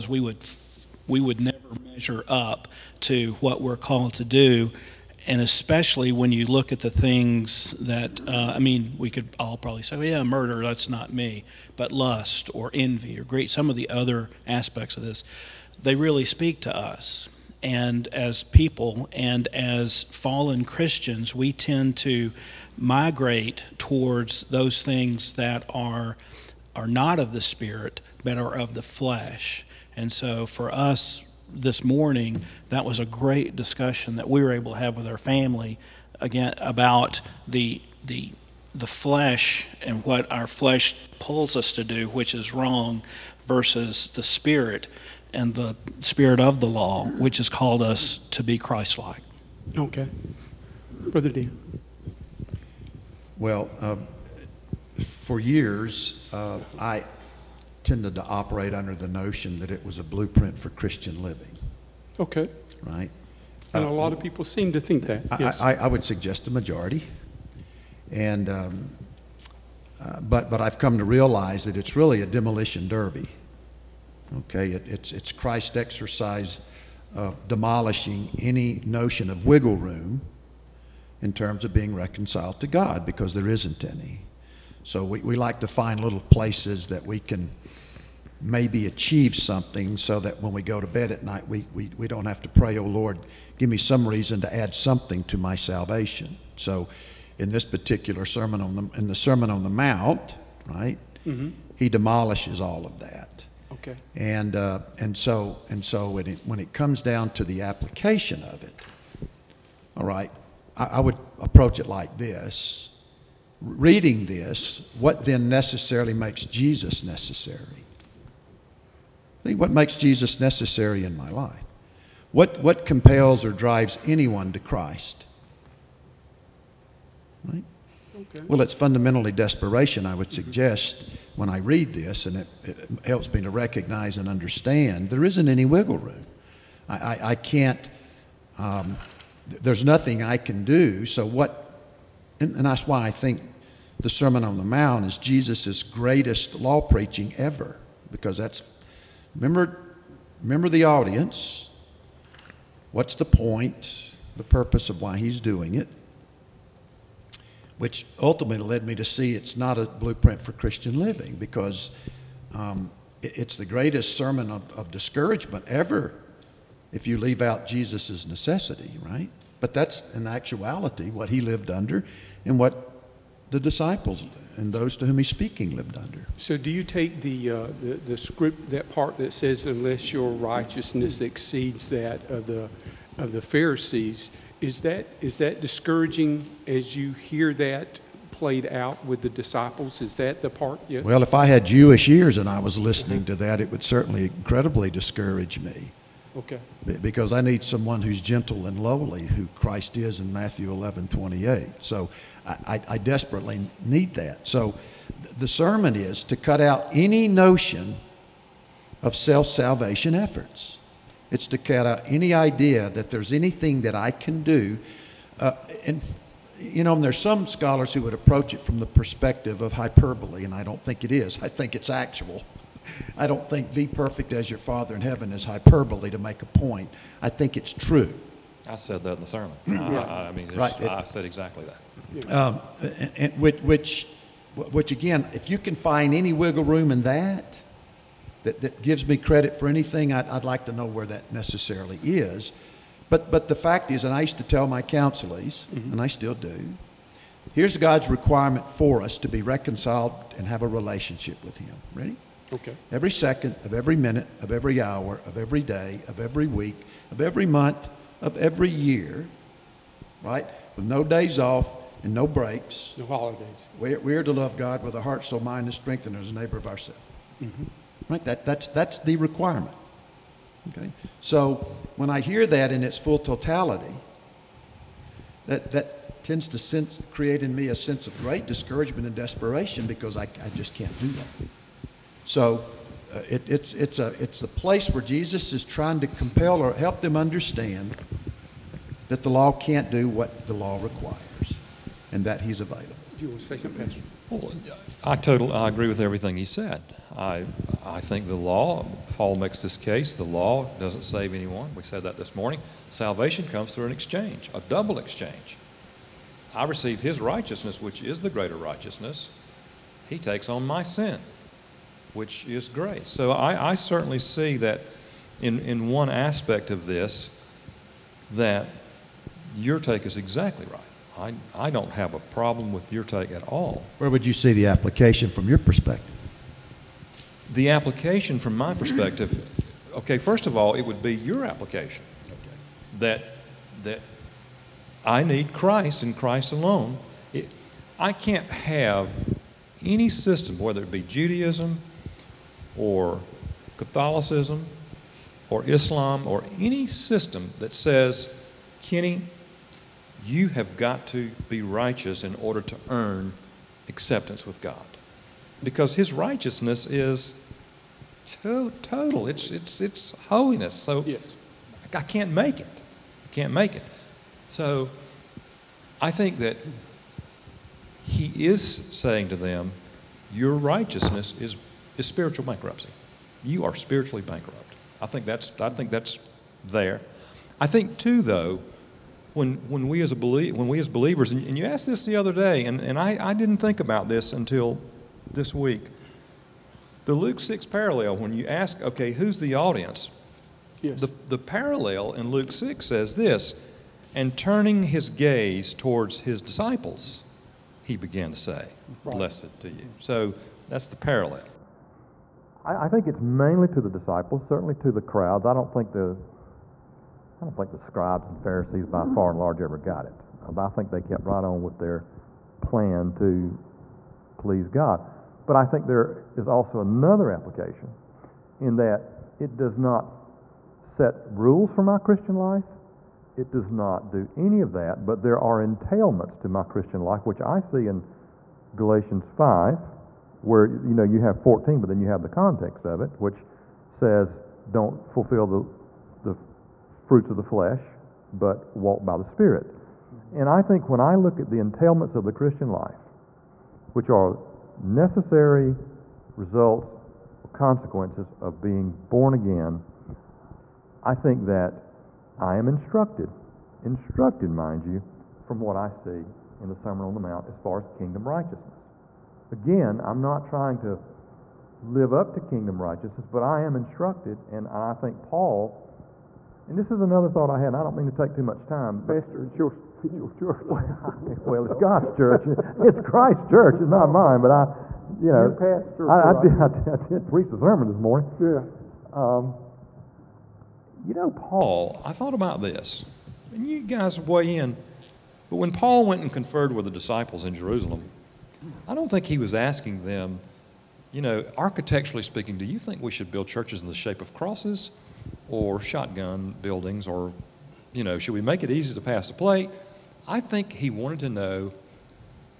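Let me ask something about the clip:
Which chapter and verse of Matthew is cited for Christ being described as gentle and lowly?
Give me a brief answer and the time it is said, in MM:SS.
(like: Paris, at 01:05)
Matthew 11:28, at 03:20.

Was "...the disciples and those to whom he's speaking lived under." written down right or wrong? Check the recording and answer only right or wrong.
right.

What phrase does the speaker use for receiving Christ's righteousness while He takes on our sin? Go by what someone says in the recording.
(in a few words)
a double exchange.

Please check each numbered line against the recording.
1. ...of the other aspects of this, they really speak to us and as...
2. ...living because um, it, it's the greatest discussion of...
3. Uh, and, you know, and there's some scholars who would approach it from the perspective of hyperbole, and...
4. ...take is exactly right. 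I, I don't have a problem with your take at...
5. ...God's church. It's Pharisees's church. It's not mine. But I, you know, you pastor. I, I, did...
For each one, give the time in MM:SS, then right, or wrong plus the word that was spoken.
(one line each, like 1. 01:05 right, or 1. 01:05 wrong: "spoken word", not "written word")
1. 00:13 right
2. 02:40 wrong: "sermon", not "discussion"
3. 03:35 right
4. 05:19 right
5. 07:51 wrong: "Christ", not "Pharisees".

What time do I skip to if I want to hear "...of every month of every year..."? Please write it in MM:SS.
04:17.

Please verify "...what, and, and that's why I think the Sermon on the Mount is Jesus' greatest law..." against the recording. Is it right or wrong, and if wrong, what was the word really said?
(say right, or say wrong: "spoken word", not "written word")
right.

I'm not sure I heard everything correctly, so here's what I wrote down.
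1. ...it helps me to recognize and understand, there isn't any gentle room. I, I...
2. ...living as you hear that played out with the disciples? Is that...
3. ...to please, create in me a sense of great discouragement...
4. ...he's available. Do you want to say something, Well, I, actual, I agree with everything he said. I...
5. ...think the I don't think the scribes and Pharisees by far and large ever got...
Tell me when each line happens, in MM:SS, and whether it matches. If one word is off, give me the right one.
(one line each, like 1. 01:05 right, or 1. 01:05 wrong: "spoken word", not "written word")
1. 02:12 wrong: "wiggle", not "gentle"
2. 03:05 wrong: "discouraging", not "living"
3. 04:36 wrong: "sense", not "please"
4. 04:52 wrong: "total", not "actual"
5. 06:45 right.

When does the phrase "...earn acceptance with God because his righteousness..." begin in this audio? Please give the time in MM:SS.
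05:52.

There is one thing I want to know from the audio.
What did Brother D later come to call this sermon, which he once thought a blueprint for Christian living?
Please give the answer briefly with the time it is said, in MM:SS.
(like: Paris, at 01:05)
a demolition derby, at 01:12.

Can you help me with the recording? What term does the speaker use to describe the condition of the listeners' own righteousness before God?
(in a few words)
spiritual bankruptcy.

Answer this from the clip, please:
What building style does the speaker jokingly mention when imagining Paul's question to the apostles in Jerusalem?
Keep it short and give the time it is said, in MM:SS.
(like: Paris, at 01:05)
shotgun buildings, at 08:15.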